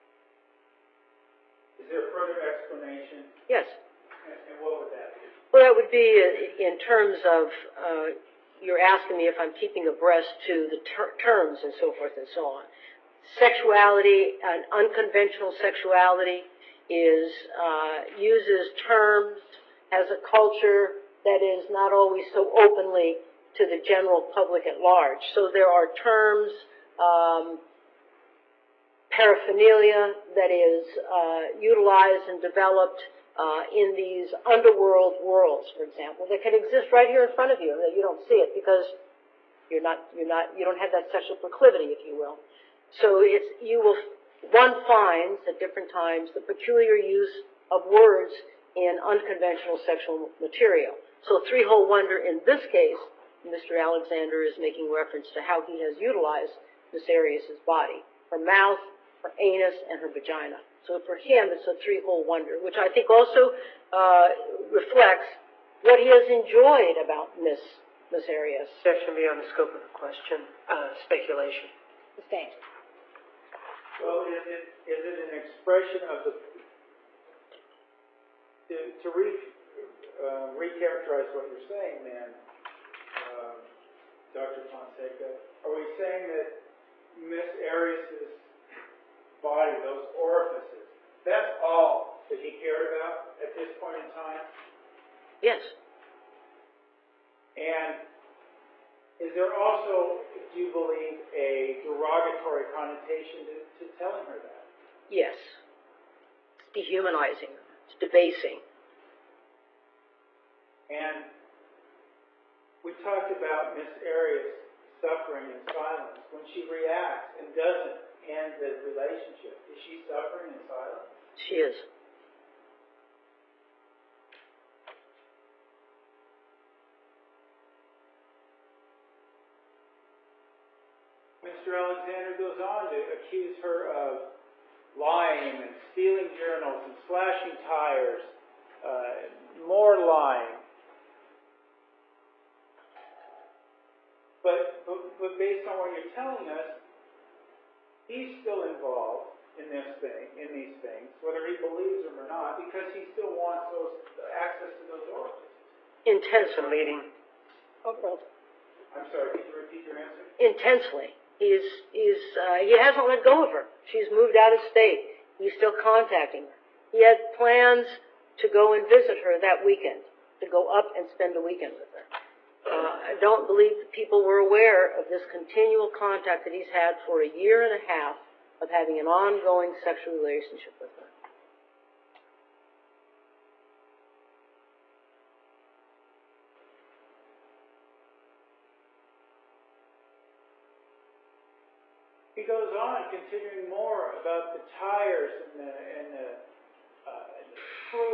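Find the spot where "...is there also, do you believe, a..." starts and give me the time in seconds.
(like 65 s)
99 s.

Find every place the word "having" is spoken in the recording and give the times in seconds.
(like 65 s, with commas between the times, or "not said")
178 s.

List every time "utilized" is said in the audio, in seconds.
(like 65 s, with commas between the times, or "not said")
31 s, 56 s.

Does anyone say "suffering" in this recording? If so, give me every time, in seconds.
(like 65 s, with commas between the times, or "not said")
114 s, 119 s.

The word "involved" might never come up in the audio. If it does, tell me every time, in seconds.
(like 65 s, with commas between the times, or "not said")
148 s.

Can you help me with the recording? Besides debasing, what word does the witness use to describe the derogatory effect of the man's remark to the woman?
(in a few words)
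Dehumanizing.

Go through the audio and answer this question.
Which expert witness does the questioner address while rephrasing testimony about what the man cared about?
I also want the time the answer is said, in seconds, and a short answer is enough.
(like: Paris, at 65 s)
Dr. Fonseca, at 84 s.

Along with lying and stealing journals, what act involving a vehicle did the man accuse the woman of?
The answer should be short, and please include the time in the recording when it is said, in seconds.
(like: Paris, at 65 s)
Slashing tires, at 136 s.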